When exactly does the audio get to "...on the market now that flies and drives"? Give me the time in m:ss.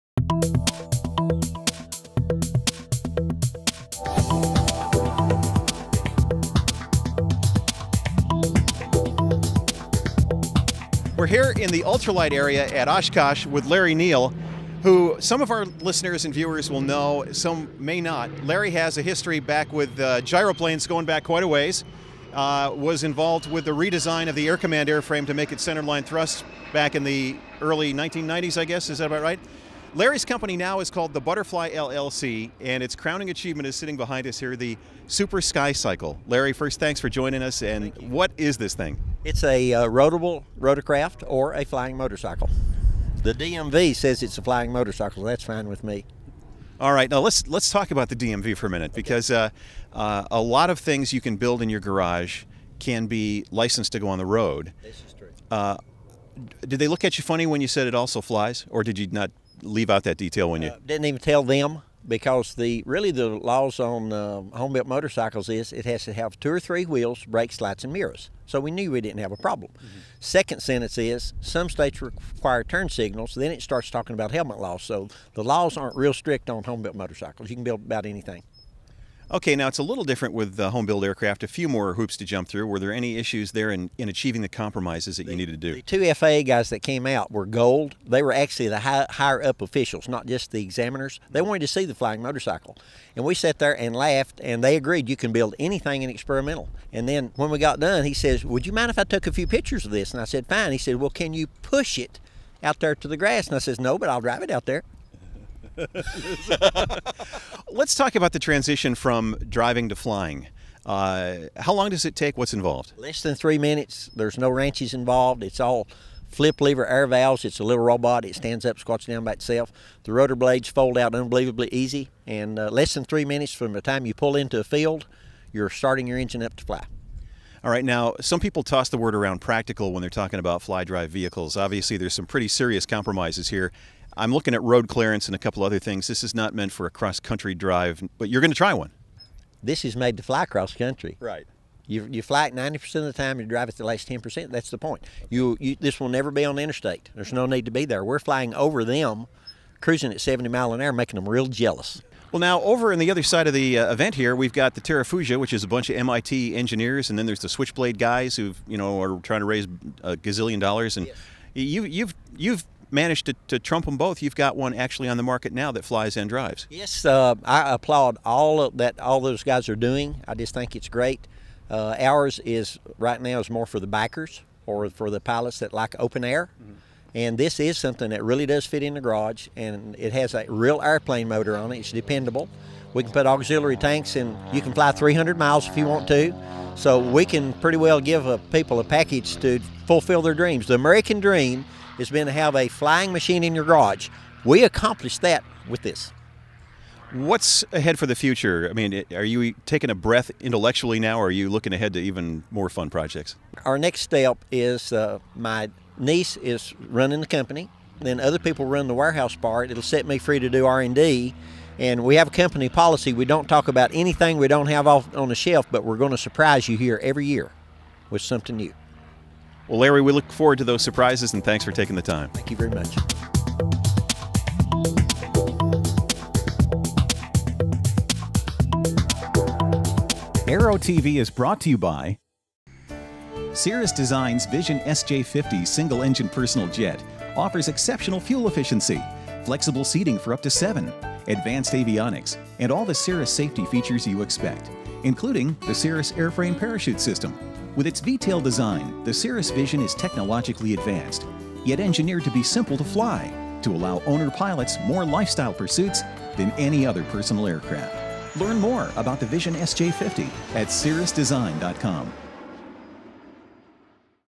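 2:45.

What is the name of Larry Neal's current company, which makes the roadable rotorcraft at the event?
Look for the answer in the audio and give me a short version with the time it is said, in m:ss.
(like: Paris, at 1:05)
Butterfly LLC, at 0:31.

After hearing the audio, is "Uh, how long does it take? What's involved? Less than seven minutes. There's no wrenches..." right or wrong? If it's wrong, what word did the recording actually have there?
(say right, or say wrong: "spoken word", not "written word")
wrong: "three", not "seven".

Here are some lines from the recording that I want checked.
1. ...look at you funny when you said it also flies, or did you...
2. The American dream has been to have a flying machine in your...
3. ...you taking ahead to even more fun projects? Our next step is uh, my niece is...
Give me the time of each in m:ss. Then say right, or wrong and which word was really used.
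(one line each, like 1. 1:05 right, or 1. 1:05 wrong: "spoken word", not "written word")
1. 0:56 right
2. 3:10 right
3. 3:21 wrong: "looking", not "taking".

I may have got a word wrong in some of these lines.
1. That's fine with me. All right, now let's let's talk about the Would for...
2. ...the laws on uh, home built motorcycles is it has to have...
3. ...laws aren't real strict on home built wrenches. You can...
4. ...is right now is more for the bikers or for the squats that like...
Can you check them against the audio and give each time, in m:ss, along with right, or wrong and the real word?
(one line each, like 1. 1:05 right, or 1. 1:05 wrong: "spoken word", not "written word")
1. 0:45 wrong: "DMV", not "Would"
2. 1:03 right
3. 1:15 wrong: "motorcycles", not "wrenches"
4. 2:52 wrong: "pilots", not "squats".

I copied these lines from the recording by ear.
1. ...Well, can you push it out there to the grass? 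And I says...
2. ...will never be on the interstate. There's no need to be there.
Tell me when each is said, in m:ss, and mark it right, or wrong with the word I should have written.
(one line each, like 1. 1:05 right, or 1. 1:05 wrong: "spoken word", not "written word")
1. 1:40 right
2. 2:25 right.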